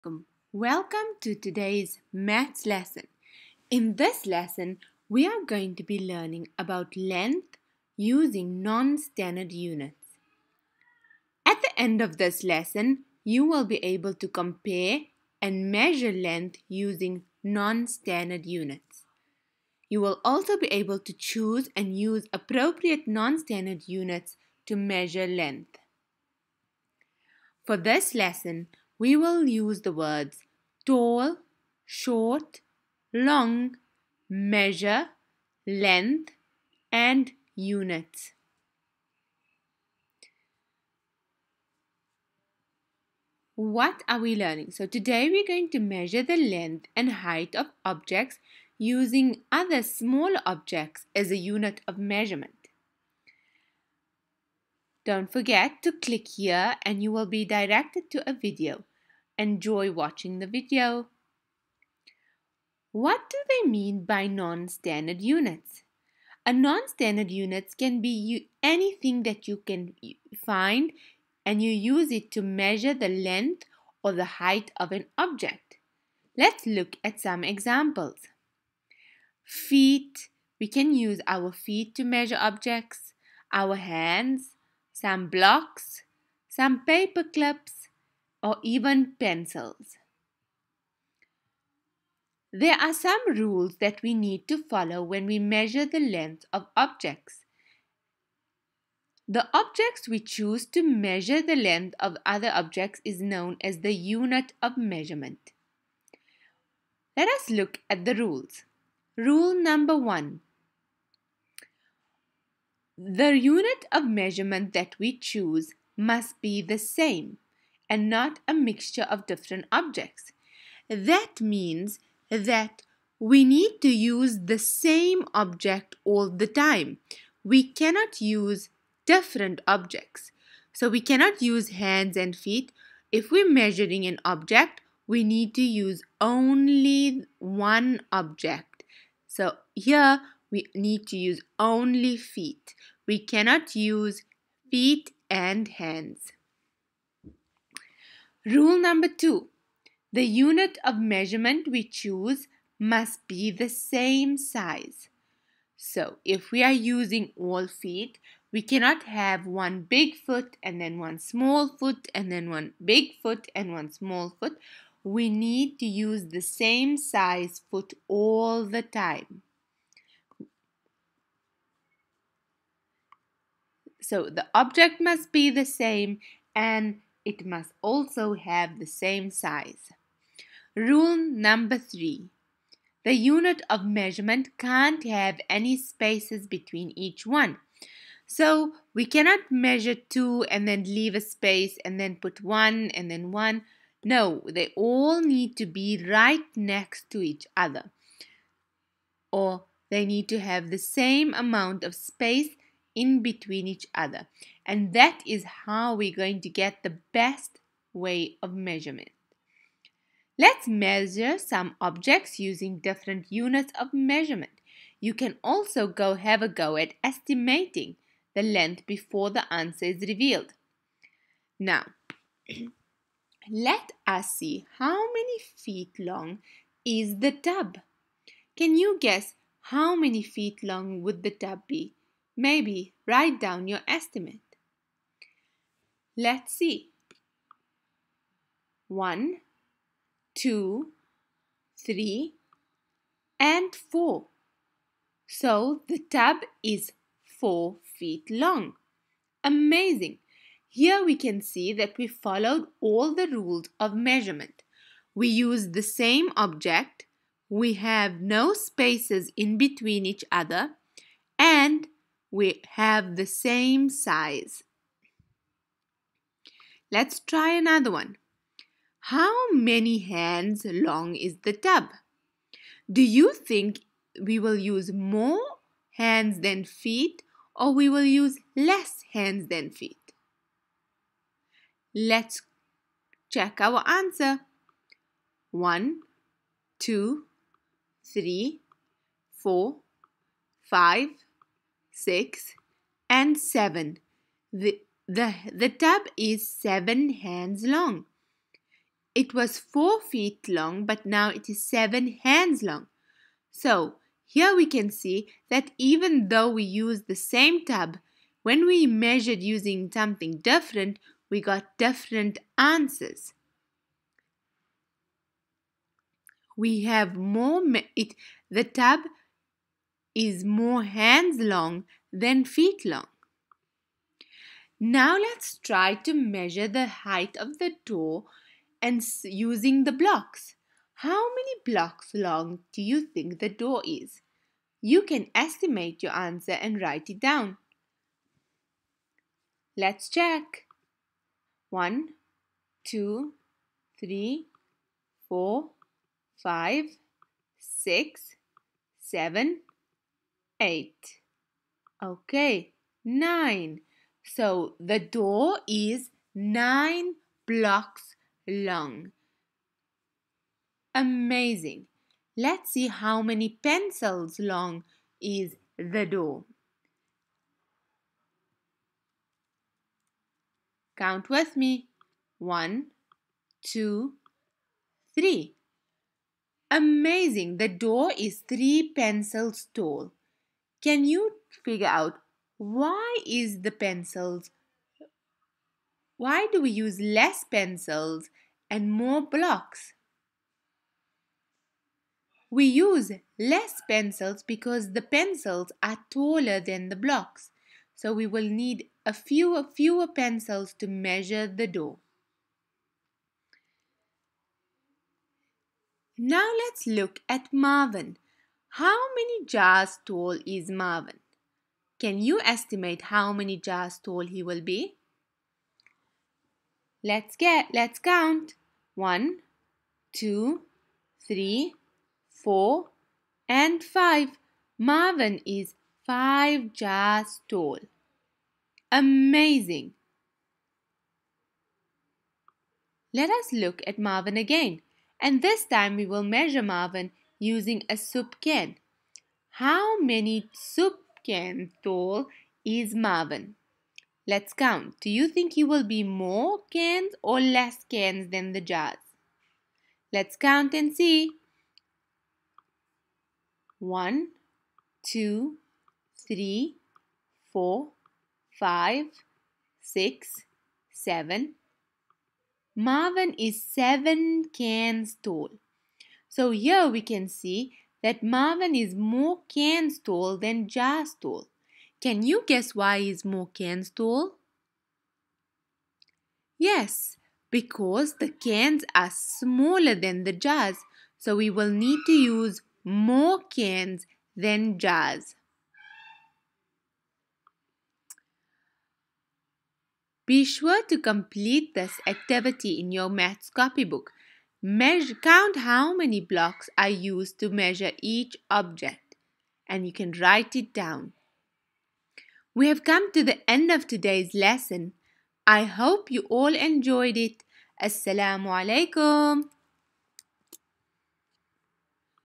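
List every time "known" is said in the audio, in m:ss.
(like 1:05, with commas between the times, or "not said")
1:43.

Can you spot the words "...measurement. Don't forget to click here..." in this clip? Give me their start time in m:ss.
0:51.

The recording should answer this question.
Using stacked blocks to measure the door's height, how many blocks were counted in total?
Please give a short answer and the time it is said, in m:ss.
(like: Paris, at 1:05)
9, at 5:56.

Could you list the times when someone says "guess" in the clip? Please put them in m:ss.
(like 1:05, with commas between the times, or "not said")
3:49, 7:52.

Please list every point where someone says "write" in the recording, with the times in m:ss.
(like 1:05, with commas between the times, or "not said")
3:53, 5:36, 8:20.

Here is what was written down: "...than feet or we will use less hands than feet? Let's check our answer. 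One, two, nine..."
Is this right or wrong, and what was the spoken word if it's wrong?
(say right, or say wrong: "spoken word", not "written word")
wrong: "three", not "nine".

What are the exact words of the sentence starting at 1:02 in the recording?
What do they mean by non-standard units?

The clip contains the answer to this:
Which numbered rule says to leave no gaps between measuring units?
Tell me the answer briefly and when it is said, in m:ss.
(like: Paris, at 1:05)
3, at 3:00.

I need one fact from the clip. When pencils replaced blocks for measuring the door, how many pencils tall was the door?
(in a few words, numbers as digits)
3.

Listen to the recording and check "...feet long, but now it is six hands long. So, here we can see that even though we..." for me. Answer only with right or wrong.
wrong.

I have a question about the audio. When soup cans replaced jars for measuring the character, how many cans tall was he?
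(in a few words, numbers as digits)
7.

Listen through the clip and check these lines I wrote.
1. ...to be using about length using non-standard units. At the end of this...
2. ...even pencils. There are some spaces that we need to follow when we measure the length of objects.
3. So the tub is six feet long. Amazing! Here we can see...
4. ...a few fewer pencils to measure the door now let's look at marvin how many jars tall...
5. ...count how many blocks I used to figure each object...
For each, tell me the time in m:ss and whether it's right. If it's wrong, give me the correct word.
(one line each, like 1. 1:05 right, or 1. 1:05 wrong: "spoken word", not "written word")
1. 0:05 wrong: "learning", not "using"
2. 1:28 wrong: "rules", not "spaces"
3. 4:05 wrong: "four", not "six"
4. 6:39 right
5. 8:15 wrong: "measure", not "figure".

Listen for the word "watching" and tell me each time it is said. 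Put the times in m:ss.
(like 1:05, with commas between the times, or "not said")
0:59.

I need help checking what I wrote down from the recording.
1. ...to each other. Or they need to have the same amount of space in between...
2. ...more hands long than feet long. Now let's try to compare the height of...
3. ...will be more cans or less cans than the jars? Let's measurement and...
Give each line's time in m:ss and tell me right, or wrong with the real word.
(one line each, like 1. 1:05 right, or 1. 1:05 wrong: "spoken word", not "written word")
1. 3:17 right
2. 5:20 wrong: "measure", not "compare"
3. 7:25 wrong: "count", not "measurement".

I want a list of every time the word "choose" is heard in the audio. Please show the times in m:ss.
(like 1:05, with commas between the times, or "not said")
0:21, 1:40, 1:55, 2:31.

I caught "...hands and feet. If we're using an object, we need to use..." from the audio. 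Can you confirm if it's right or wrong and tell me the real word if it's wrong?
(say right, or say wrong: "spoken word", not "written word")
wrong: "measuring", not "using".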